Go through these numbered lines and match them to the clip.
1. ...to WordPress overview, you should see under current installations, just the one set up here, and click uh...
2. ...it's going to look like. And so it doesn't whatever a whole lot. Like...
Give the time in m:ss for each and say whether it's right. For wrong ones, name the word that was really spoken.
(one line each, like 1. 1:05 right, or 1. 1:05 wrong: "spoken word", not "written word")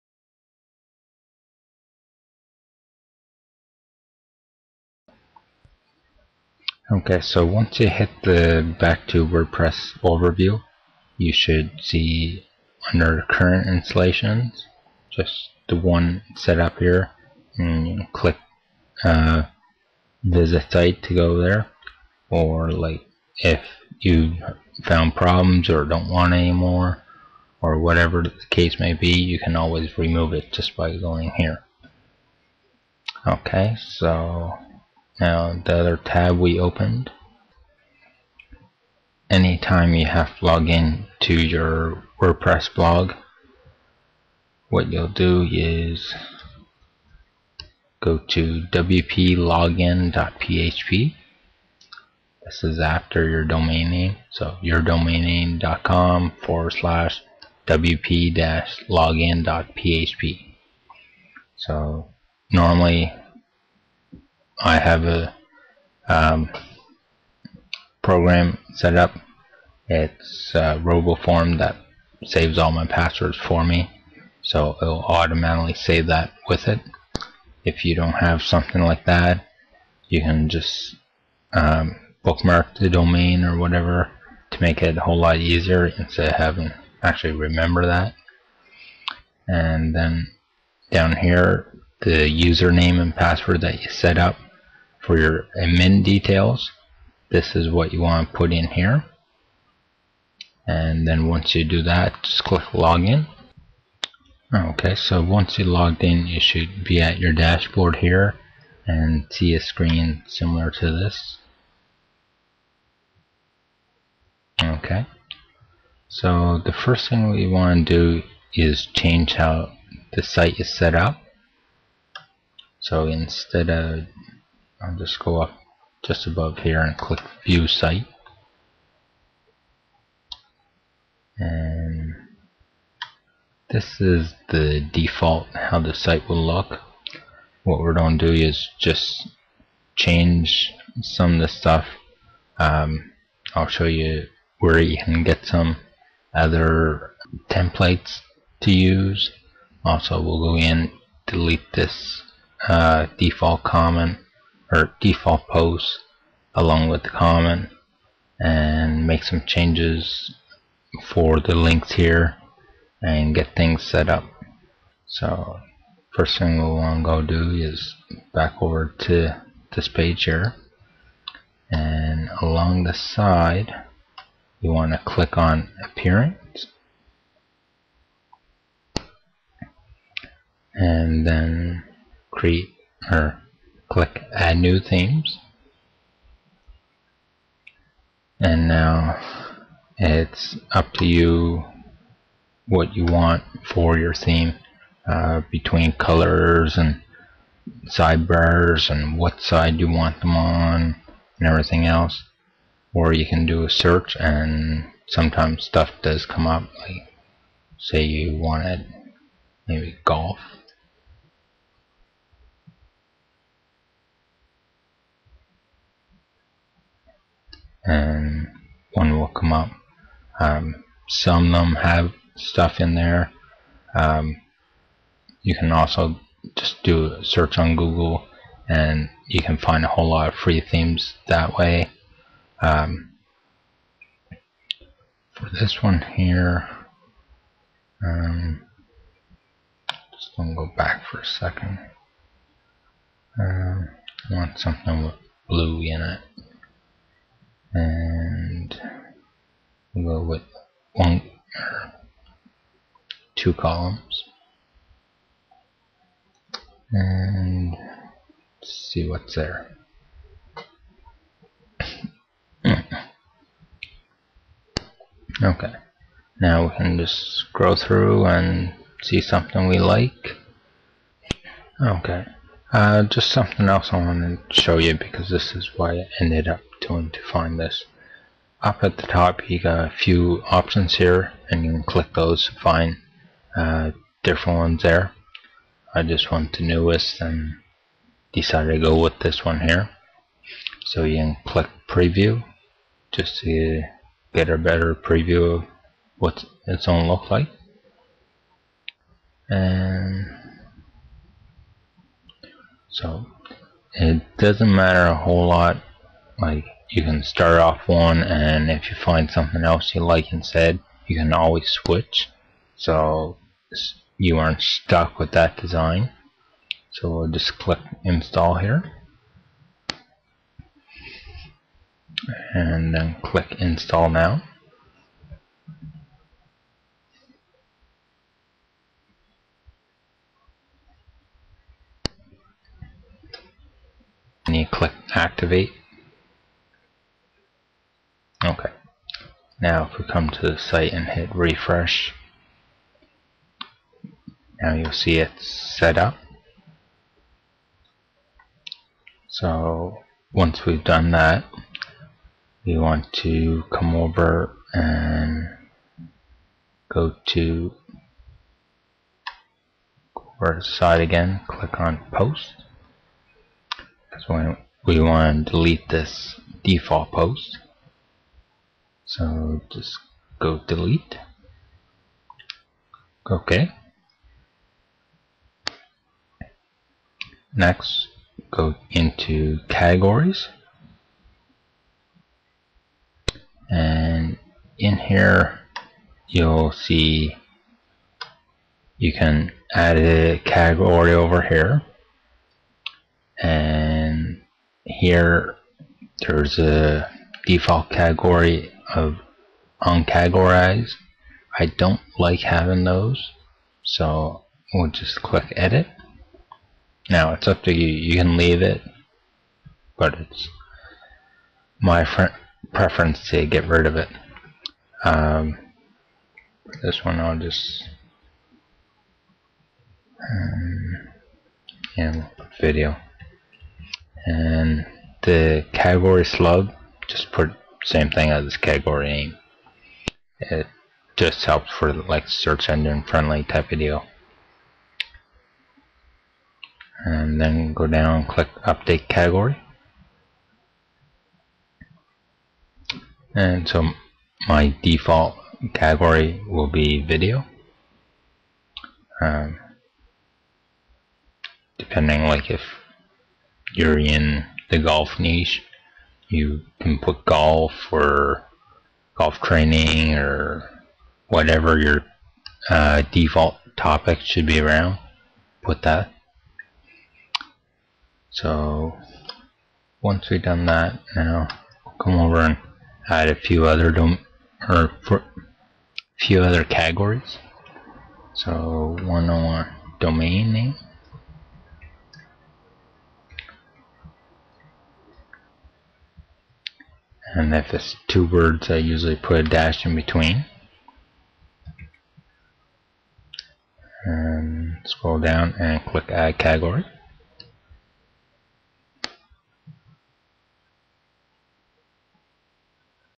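1. 0:09 right
2. 4:56 wrong: "matter", not "whatever".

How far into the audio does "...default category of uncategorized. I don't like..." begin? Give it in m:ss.
6:37.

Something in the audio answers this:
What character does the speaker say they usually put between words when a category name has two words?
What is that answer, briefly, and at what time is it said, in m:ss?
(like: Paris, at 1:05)
a dash, at 8:09.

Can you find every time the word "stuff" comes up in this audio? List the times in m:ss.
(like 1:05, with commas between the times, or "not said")
2:21, 3:25, 3:42.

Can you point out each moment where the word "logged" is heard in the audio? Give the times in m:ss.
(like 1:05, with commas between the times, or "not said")
1:45.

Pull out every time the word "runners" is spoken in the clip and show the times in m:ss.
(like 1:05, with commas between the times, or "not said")
not said.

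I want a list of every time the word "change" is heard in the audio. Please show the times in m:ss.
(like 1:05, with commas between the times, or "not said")
1:58, 2:19, 2:39.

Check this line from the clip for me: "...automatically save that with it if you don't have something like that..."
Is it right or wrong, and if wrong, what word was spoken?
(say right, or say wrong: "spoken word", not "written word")
right.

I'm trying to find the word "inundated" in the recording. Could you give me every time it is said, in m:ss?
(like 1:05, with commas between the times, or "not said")
not said.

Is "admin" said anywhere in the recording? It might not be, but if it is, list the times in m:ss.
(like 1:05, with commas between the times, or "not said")
1:35.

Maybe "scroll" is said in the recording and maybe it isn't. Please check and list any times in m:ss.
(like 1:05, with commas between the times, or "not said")
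4:27, 8:14.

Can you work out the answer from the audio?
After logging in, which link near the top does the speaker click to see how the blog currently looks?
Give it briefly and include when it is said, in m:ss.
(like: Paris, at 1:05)
view site, at 2:07.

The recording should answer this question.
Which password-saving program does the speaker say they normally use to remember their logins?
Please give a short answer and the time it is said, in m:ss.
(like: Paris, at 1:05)
RoboForm, at 1:10.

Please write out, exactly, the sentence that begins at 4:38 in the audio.
Up at the top you got a few options here and you can click those to find uh, different ones there.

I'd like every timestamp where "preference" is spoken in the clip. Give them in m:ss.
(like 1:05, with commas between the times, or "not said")
6:52.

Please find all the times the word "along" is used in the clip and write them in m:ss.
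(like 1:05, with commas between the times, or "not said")
2:36, 2:52.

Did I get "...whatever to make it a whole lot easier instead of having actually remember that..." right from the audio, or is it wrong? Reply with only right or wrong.
right.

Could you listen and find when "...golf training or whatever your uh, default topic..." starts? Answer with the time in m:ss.
7:39.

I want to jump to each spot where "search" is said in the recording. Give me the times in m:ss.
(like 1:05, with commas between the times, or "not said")
3:23, 3:47, 7:12.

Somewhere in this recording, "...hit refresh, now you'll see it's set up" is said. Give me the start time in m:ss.
5:41.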